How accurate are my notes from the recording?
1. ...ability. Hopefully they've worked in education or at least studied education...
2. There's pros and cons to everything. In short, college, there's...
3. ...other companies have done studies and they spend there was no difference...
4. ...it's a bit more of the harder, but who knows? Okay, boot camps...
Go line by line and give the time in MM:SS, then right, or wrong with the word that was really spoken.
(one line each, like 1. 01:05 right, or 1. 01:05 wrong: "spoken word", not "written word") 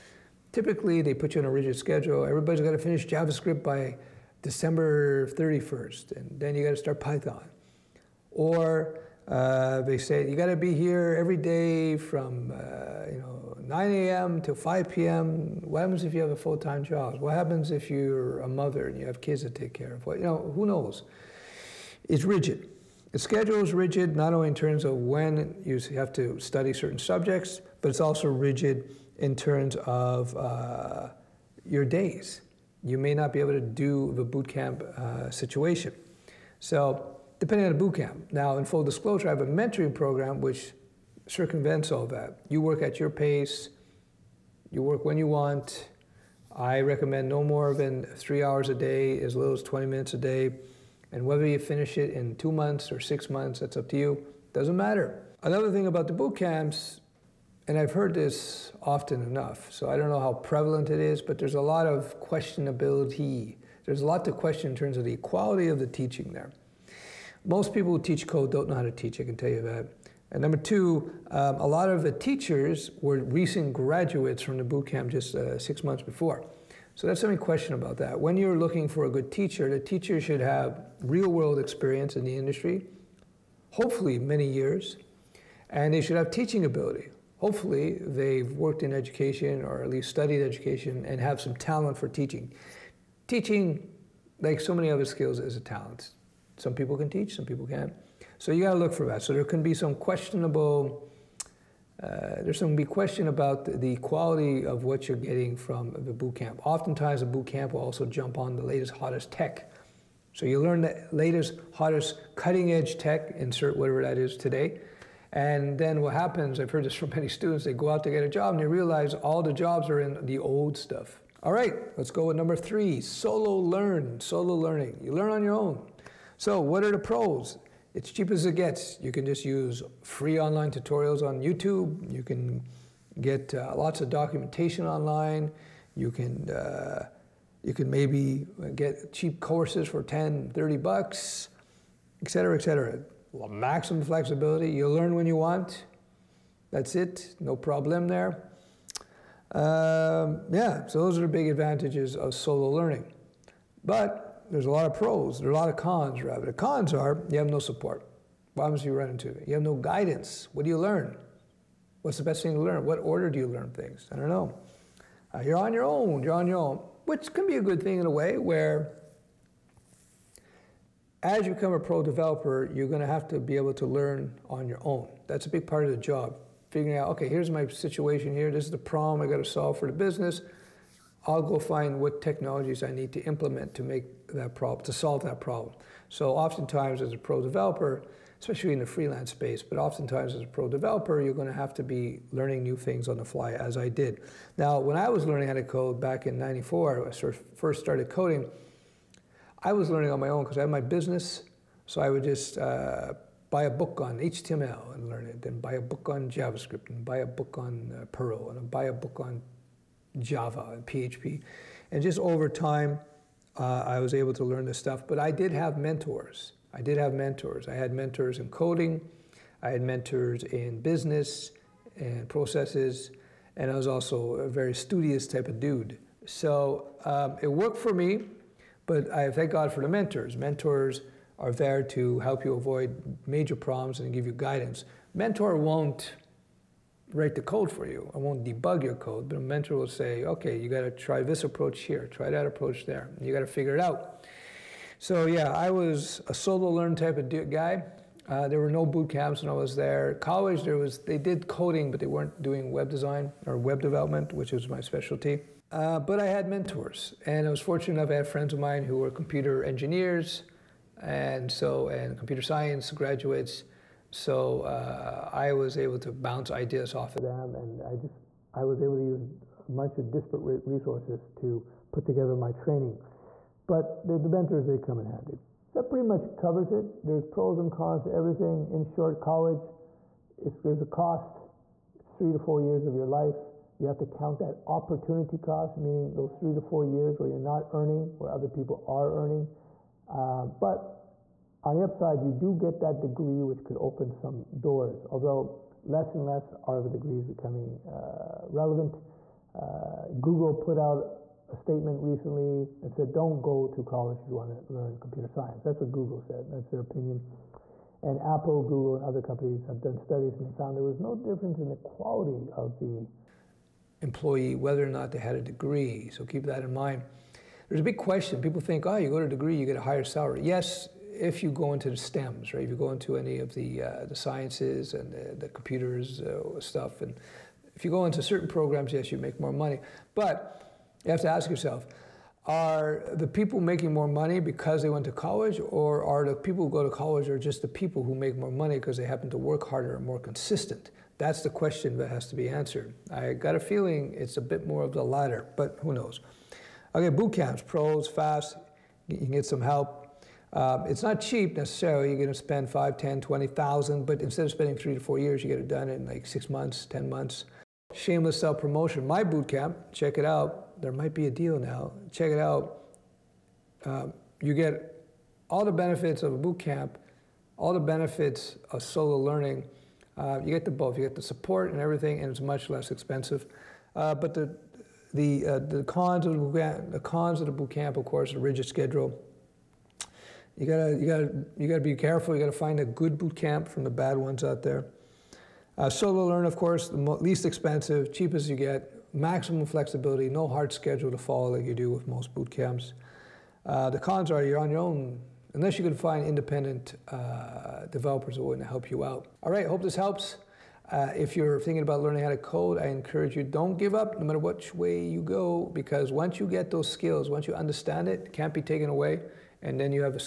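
1. 01:26 right
2. 04:37 right
3. 05:09 wrong: "found", not "spend"
4. 05:44 wrong: "latter", not "harder".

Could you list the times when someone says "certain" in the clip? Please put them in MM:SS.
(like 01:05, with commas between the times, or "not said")
00:26, 05:28.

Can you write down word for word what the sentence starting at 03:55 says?
Mentor won't write the code for you.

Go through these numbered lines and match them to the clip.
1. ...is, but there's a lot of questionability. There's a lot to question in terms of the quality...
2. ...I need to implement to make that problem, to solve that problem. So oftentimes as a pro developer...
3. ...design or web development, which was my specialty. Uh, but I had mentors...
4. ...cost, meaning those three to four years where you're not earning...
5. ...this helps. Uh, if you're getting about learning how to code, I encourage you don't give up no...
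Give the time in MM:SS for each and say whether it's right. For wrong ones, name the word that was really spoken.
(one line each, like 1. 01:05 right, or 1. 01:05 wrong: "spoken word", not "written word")
1. 01:01 right
2. 03:02 right
3. 04:12 right
4. 04:45 right
5. 06:39 wrong: "thinking", not "getting".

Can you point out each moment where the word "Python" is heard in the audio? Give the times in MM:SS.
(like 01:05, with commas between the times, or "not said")
00:06.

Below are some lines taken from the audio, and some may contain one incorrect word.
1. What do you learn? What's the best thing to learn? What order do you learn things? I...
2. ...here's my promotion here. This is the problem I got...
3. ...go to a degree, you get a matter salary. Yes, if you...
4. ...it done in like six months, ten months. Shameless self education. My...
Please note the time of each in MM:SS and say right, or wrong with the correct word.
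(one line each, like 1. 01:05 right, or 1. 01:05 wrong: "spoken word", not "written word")
1. 02:40 right
2. 02:57 wrong: "situation", not "promotion"
3. 05:19 wrong: "higher", not "matter"
4. 05:55 wrong: "promotion", not "education".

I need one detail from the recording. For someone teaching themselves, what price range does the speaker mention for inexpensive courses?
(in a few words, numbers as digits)
10 to 30 dollars.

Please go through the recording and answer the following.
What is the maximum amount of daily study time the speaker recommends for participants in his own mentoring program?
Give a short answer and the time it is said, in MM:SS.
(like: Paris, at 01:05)
3 hours, at 00:48.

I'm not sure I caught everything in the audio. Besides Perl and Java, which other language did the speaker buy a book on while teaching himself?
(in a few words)
PHP.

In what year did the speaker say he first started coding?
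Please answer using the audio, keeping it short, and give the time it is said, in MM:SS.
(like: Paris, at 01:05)
1994, at 03:16.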